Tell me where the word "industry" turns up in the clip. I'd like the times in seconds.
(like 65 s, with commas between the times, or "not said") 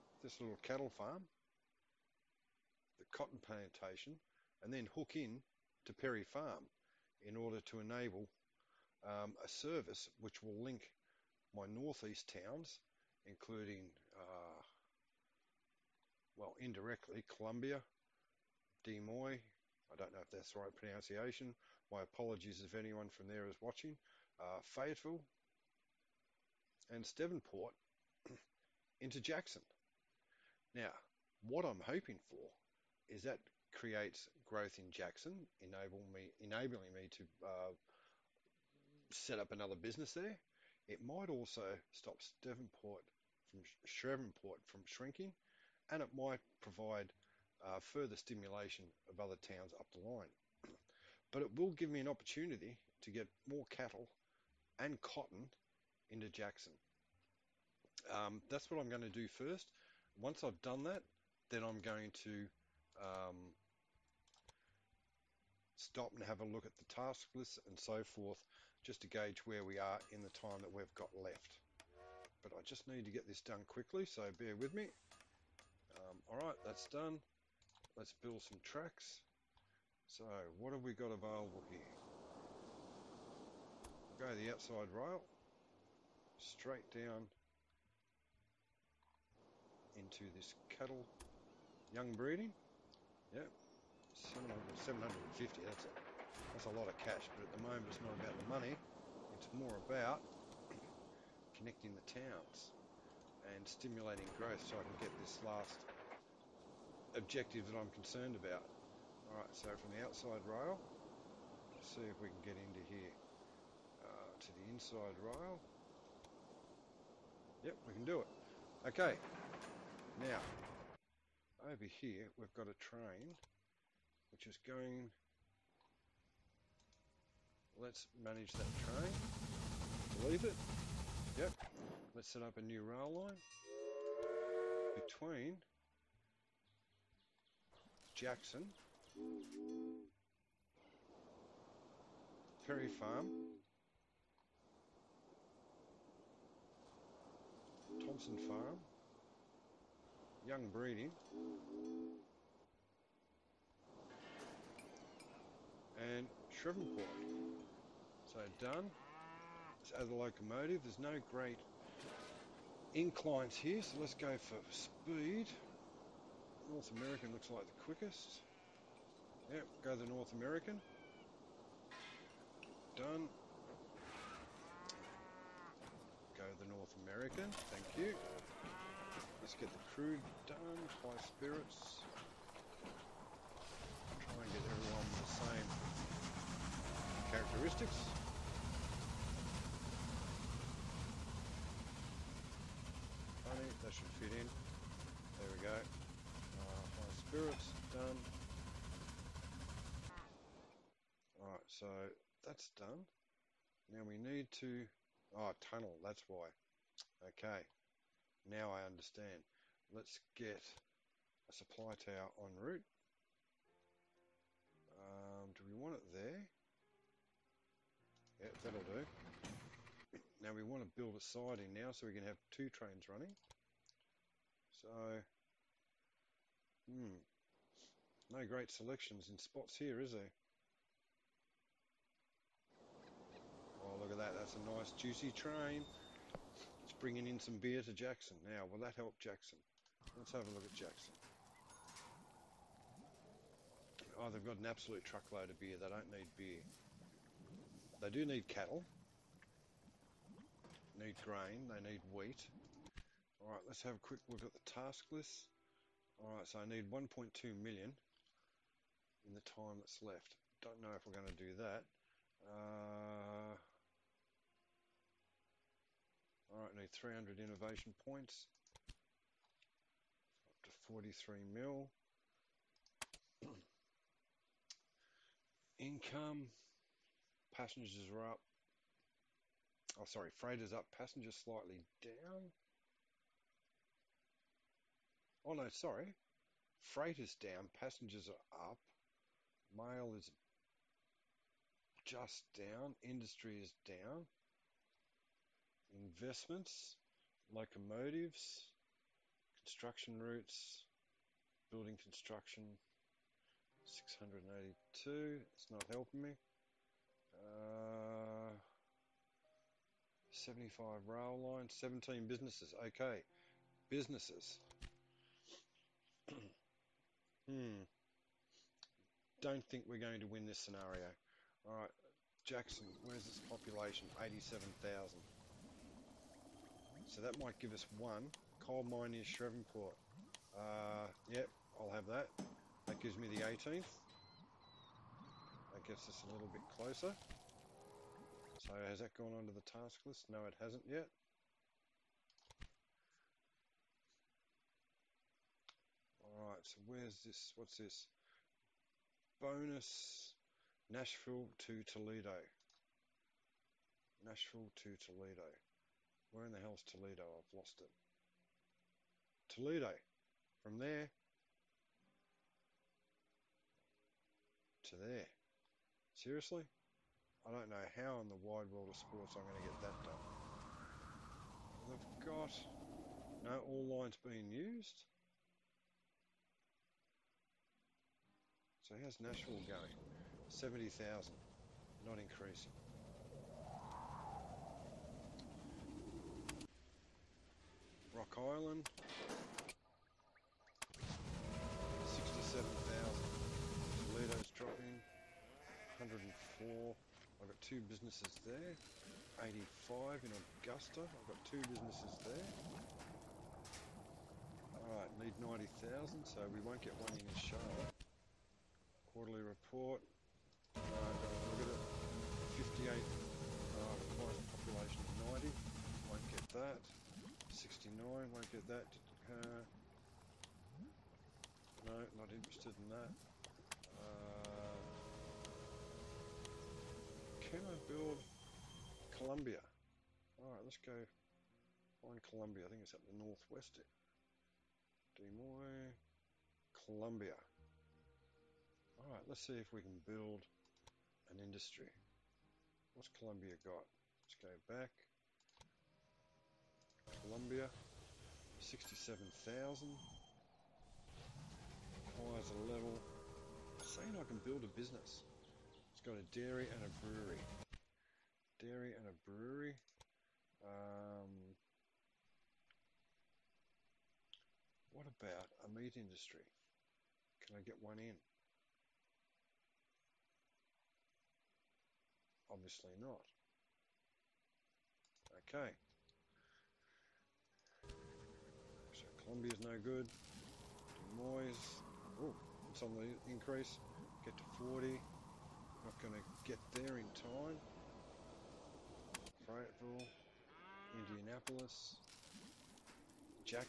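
293 s, 441 s, 465 s.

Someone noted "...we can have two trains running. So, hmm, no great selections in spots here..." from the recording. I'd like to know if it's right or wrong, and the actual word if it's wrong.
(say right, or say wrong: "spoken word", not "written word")
right.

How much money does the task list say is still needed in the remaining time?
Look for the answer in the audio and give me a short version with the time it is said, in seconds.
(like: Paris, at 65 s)
1.2 million, at 256 s.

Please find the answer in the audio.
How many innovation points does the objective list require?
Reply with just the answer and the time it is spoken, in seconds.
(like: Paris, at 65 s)
300, at 266 s.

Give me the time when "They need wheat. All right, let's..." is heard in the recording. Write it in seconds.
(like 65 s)
251 s.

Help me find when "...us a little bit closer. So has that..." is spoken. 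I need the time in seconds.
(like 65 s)
336 s.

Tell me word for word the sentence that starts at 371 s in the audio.
They've got no all lines being used.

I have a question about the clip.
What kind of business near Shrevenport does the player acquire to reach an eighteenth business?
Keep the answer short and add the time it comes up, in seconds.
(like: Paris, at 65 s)
Coal mine, at 328 s.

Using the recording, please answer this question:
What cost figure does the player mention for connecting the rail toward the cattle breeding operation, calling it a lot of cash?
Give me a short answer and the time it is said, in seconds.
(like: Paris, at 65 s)
750, at 94 s.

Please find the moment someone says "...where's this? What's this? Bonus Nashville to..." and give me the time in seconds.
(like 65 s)
346 s.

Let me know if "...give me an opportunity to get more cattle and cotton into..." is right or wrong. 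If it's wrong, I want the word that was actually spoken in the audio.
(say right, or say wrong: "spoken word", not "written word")
right.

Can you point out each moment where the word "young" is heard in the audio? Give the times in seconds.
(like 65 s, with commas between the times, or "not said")
91 s, 150 s.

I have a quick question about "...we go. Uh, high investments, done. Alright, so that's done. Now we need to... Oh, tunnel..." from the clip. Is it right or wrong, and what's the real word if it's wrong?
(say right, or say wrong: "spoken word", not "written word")
wrong: "spirits", not "investments".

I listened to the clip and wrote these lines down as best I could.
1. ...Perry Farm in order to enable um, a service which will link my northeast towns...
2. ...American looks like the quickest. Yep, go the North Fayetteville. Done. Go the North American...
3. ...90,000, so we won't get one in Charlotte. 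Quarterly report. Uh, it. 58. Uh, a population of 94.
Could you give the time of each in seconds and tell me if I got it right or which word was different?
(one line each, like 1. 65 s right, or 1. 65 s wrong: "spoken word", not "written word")
1. 5 s right
2. 166 s wrong: "American", not "Fayetteville"
3. 405 s wrong: "90", not "94".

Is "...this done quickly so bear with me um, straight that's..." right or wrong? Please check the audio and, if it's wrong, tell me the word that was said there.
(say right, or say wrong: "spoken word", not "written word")
wrong: "alright", not "straight".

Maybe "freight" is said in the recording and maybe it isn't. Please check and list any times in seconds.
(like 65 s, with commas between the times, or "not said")
280 s, 286 s.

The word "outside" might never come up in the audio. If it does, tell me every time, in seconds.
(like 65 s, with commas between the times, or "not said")
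84 s, 110 s.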